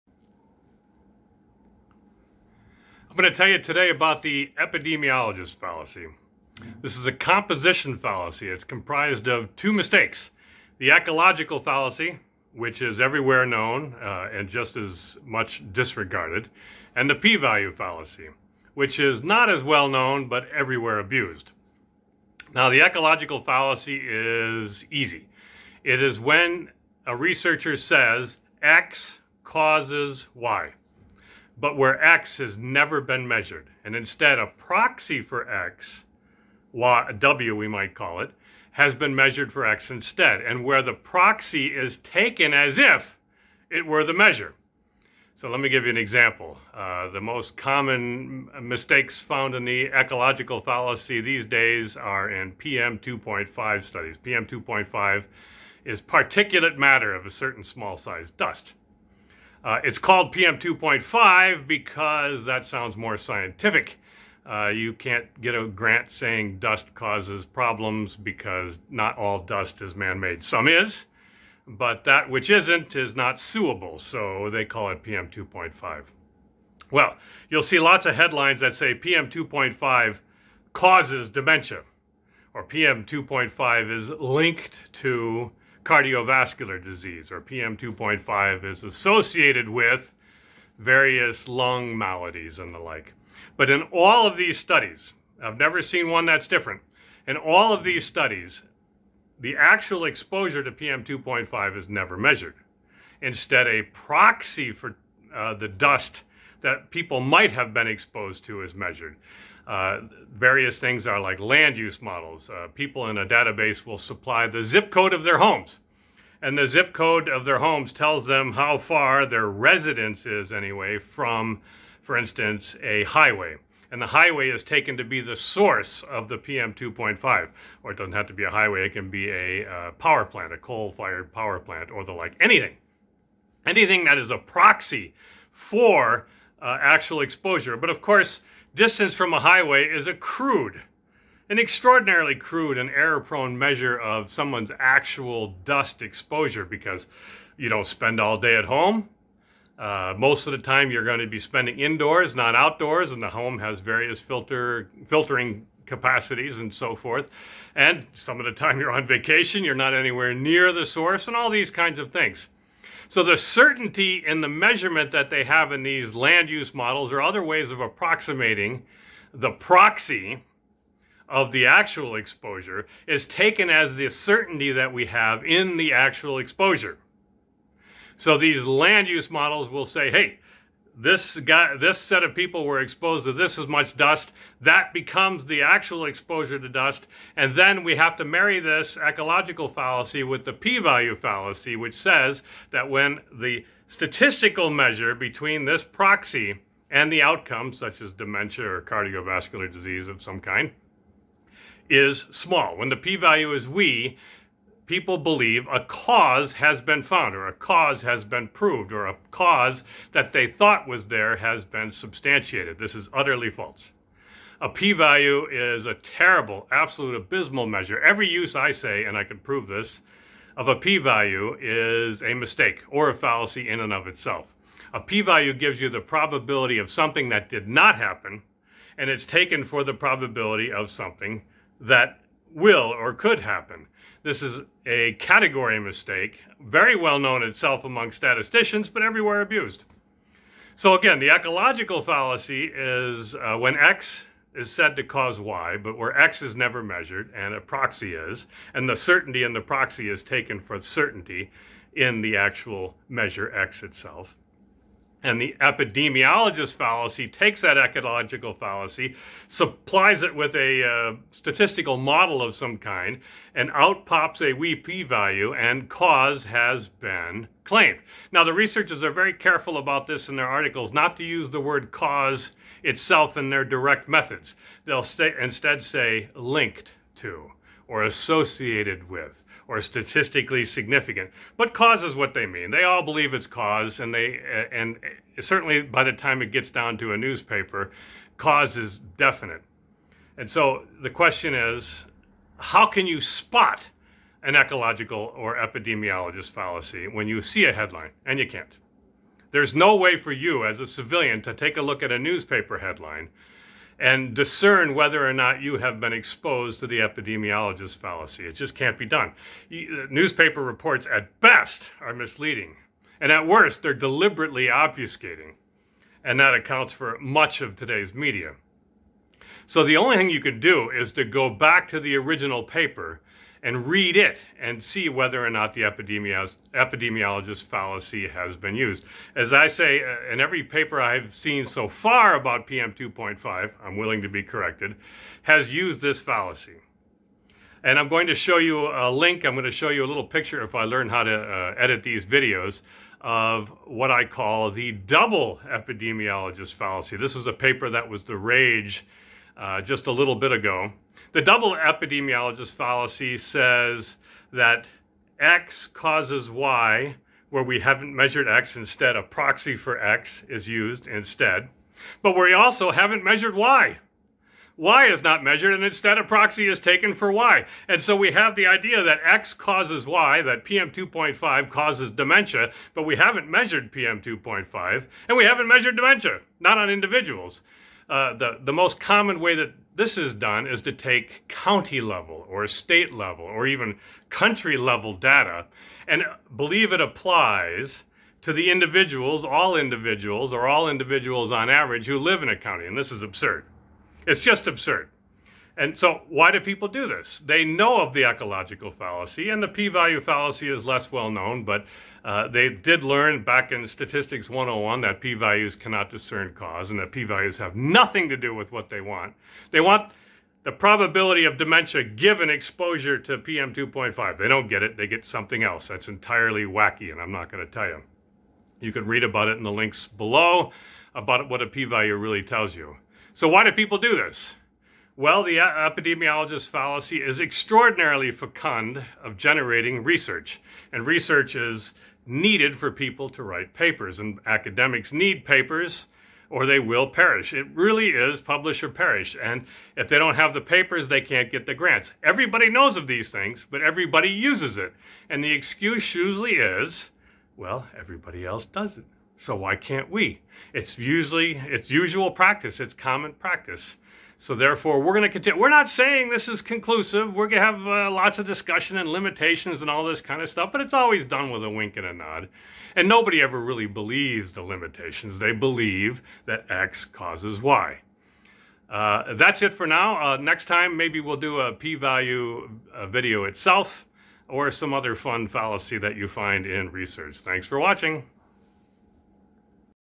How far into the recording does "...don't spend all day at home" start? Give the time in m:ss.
2:27.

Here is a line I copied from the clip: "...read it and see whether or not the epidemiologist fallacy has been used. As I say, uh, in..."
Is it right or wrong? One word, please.
right.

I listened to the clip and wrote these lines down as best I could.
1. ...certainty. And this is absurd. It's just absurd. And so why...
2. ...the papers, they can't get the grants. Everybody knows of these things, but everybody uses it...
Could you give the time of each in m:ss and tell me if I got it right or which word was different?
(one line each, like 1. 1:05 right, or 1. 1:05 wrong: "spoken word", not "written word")
1. 6:32 wrong: "county", not "certainty"
2. 7:20 right.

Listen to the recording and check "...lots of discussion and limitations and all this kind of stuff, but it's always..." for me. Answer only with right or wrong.
right.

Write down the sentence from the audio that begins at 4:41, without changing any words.
But cause is what they mean.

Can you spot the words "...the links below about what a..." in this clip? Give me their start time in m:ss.
6:59.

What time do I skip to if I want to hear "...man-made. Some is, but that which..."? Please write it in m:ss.
1:09.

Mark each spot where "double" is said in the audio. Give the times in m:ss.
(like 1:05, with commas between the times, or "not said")
5:44, 5:51.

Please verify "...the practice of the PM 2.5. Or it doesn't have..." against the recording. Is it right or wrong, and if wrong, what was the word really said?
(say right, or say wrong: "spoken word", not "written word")
wrong: "source", not "practice".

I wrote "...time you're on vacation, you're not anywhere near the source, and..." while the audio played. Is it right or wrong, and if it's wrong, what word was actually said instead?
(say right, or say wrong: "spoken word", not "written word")
right.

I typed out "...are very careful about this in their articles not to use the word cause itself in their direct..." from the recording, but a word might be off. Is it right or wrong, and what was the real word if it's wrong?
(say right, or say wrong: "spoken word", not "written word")
right.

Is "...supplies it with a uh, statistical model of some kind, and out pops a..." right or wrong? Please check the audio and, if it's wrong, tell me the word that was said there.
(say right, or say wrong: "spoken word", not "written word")
right.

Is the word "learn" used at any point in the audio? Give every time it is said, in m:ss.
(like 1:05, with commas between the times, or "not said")
5:40, 6:43.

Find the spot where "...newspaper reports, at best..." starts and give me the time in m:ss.
5:10.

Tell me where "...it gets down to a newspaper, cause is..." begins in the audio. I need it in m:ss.
4:46.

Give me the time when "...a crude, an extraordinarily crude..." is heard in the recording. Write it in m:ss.
2:20.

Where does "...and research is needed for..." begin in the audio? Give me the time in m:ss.
7:10.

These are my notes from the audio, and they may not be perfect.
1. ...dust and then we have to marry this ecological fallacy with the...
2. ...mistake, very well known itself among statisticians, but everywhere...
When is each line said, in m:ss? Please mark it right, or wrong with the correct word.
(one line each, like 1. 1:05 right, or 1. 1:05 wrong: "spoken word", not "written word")
1. 3:06 right
2. 3:55 right.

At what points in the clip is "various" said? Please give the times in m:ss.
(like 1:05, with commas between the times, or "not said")
1:30, 1:50, 2:33.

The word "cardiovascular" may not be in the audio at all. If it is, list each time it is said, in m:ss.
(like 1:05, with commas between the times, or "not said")
1:25, 3:18.